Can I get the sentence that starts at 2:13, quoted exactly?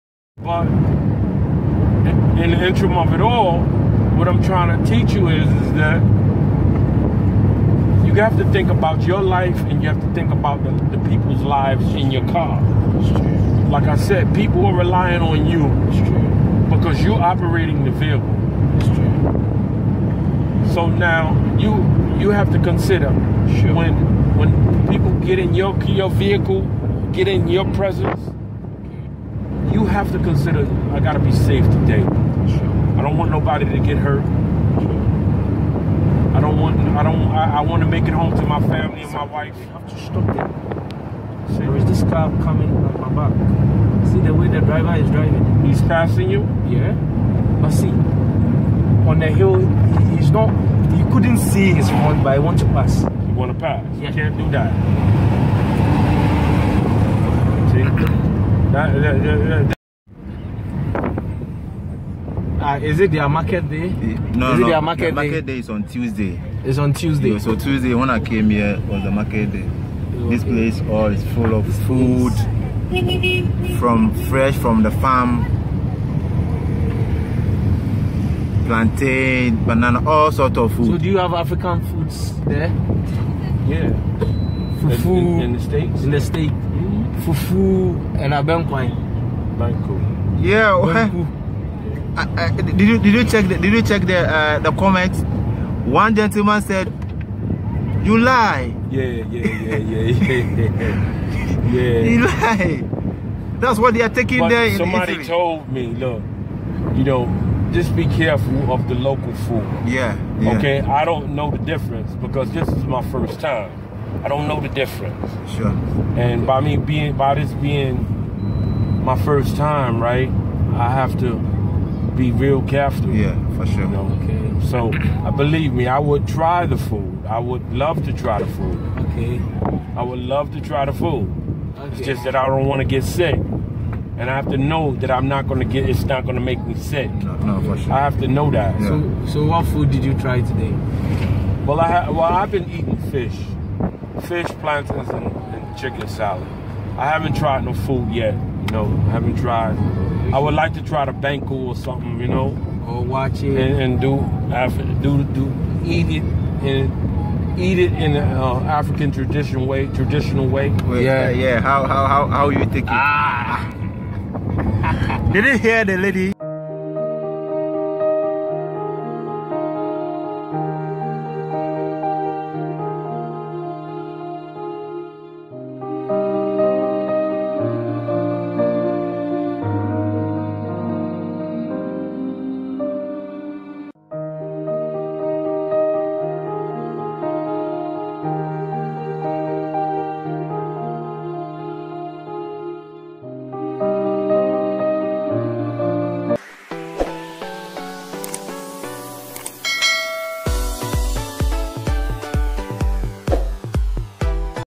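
And I have to know that I'm not going to get, it's not going to make me sick.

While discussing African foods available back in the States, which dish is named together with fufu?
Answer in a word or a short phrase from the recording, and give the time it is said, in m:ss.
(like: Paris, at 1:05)
Abenkwan, at 1:28.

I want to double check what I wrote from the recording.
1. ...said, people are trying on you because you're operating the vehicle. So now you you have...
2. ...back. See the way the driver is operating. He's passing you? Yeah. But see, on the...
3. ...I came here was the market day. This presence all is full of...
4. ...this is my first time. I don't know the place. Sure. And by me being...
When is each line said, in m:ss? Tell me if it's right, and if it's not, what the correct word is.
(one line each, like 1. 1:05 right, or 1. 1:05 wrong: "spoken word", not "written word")
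1. 0:13 wrong: "relying", not "trying"
2. 0:43 wrong: "driving", not "operating"
3. 1:08 wrong: "place", not "presence"
4. 1:52 wrong: "difference", not "place".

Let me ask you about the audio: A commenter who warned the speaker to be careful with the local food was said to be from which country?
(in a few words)
Italy.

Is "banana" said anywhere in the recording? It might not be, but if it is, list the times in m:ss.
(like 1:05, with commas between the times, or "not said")
1:19.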